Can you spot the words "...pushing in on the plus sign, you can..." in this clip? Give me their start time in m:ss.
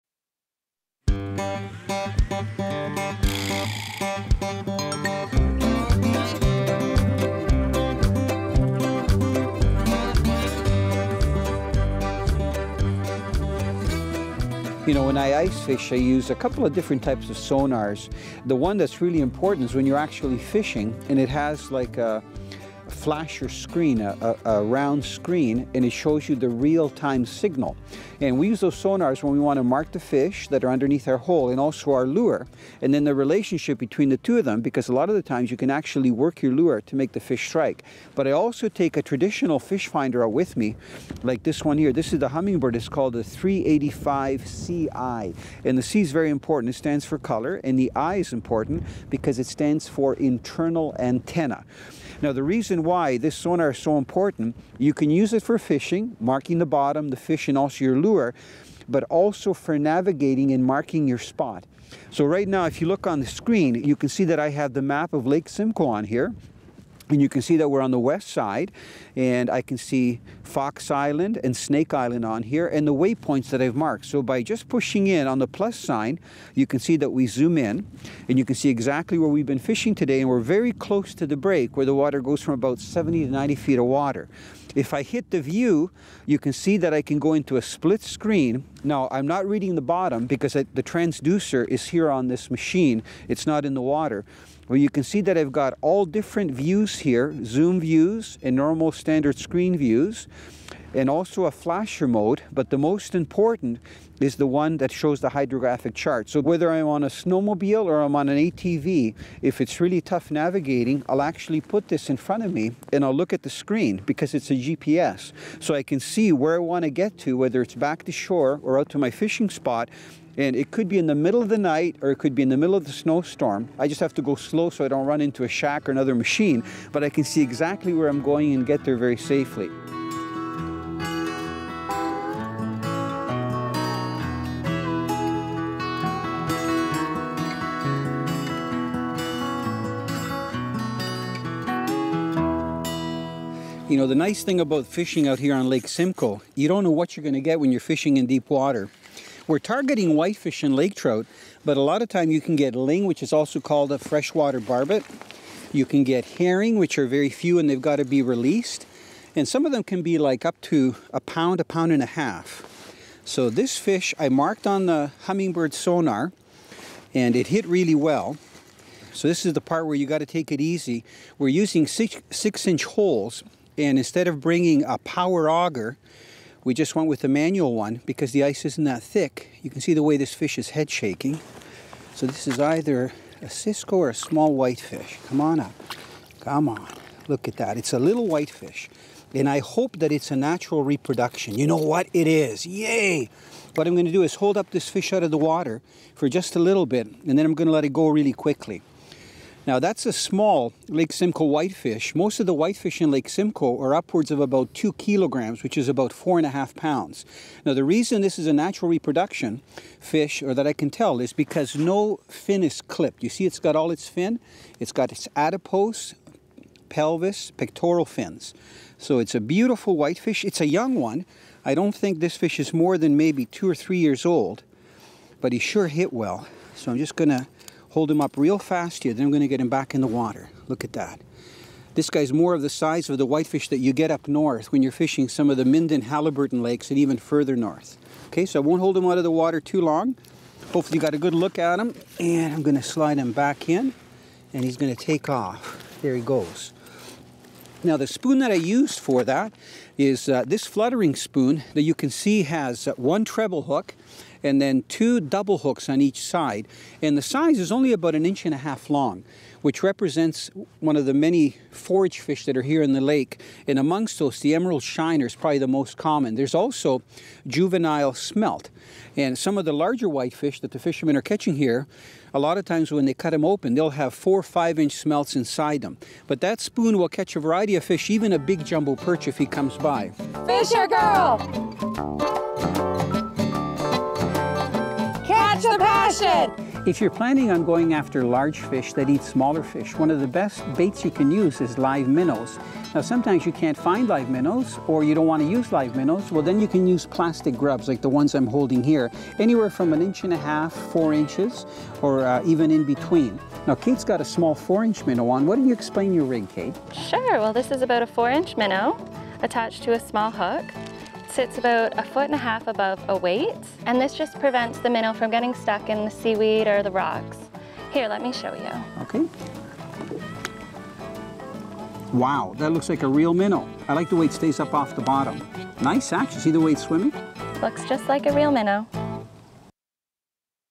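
1:14.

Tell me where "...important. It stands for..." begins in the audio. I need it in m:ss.
0:46.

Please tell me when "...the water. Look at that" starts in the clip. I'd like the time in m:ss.
3:49.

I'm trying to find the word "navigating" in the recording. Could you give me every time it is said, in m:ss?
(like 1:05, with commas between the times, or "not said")
0:59, 1:50.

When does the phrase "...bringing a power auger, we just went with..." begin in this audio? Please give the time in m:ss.
2:54.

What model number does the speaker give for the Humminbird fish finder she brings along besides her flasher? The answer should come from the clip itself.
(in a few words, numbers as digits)
385 CI.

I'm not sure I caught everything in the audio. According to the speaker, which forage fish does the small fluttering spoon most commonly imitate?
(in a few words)
emerald shiner.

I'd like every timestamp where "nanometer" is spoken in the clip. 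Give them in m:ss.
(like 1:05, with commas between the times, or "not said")
not said.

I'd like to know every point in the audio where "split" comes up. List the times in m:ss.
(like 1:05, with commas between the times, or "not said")
1:27.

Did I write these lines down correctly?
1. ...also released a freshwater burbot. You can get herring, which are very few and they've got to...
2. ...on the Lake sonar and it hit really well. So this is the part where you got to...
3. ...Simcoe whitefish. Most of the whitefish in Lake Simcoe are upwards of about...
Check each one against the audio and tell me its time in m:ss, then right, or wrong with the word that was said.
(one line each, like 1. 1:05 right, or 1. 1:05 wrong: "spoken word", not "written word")
1. 2:33 wrong: "called", not "released"
2. 2:44 wrong: "Humminbird", not "Lake"
3. 3:21 right.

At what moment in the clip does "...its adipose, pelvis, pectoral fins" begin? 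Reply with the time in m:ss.
3:35.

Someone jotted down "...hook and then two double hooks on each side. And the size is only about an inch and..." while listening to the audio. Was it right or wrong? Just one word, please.
right.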